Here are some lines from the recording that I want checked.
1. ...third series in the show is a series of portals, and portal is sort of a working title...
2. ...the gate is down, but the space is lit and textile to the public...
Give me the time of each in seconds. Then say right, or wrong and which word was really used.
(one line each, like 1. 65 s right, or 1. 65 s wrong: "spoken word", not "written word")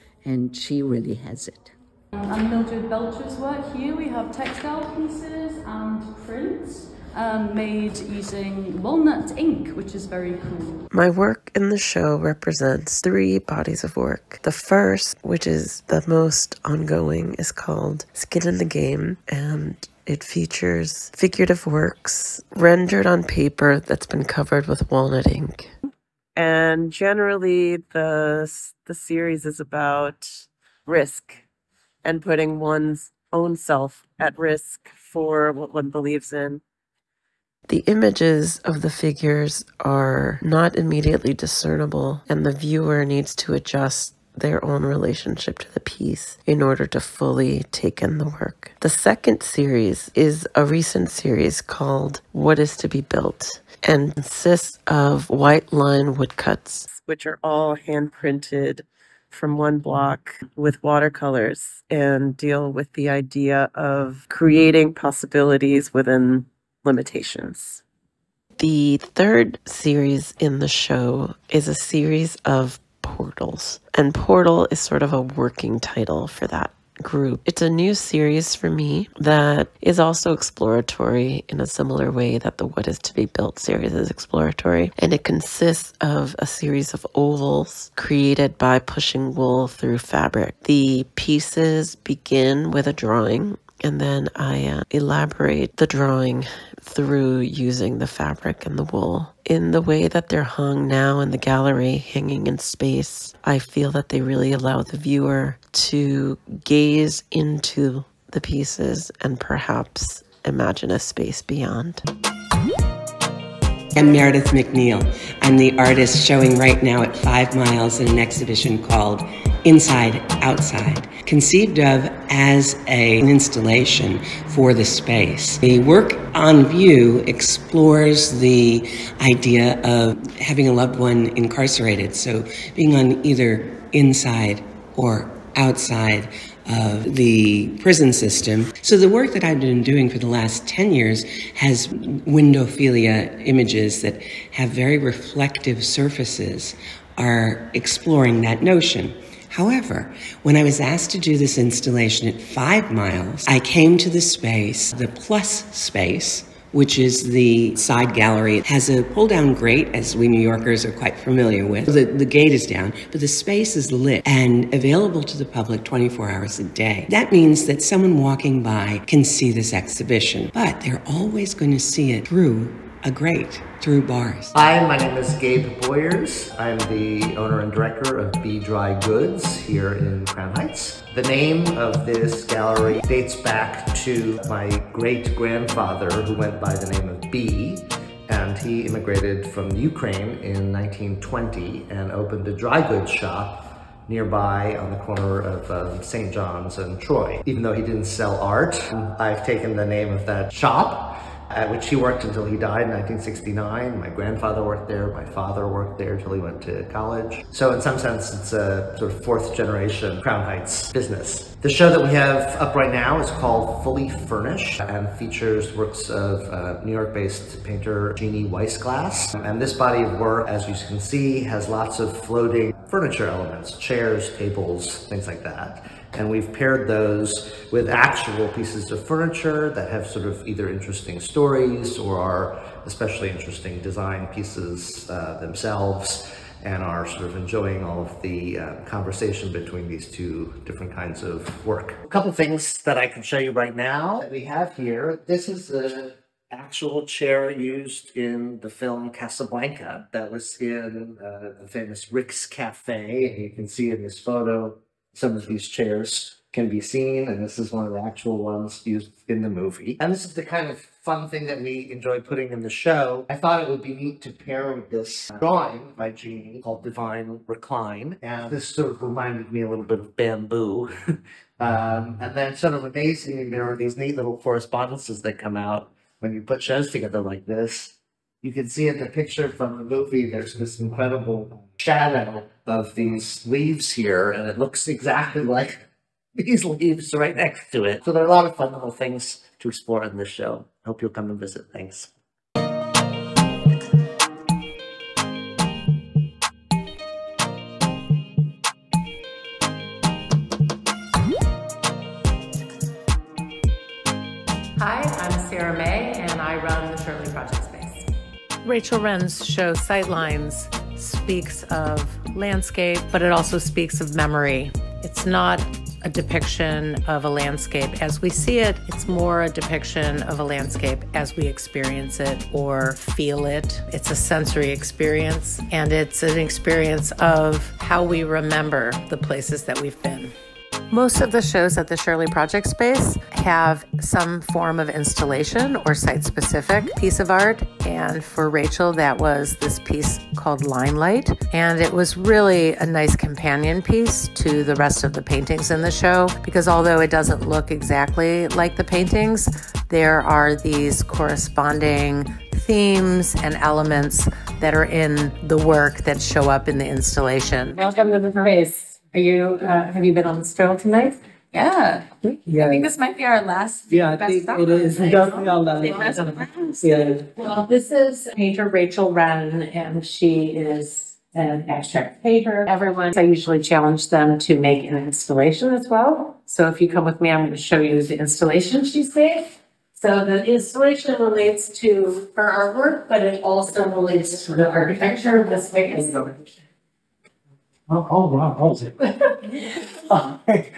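1. 68 s right
2. 162 s wrong: "available", not "textile".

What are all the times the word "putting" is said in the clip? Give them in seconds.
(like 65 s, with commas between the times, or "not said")
32 s, 262 s.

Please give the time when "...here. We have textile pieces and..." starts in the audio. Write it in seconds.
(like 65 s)
3 s.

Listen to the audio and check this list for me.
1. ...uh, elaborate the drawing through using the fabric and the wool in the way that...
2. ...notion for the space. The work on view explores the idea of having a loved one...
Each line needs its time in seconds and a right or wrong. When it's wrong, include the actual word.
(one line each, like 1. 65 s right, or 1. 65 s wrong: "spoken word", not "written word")
1. 94 s right
2. 123 s wrong: "installation", not "notion".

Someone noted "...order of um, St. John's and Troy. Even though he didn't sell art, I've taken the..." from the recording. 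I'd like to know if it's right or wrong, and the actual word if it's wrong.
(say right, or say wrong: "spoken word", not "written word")
wrong: "corner", not "order".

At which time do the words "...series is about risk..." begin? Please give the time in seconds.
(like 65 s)
28 s.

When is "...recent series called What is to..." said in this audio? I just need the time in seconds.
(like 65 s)
50 s.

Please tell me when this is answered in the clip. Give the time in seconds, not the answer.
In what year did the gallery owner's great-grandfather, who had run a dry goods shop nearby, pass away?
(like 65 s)
202 s.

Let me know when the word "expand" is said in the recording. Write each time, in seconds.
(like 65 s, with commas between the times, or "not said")
not said.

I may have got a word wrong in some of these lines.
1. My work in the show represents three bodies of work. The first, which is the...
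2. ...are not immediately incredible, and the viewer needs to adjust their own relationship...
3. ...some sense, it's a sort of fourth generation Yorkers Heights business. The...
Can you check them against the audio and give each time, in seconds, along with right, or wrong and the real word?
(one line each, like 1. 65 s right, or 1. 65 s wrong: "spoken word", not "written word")
1. 10 s right
2. 39 s wrong: "discernible", not "incredible"
3. 207 s wrong: "Crown", not "Yorkers".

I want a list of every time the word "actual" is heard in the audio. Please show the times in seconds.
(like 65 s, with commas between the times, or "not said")
227 s, 246 s, 257 s.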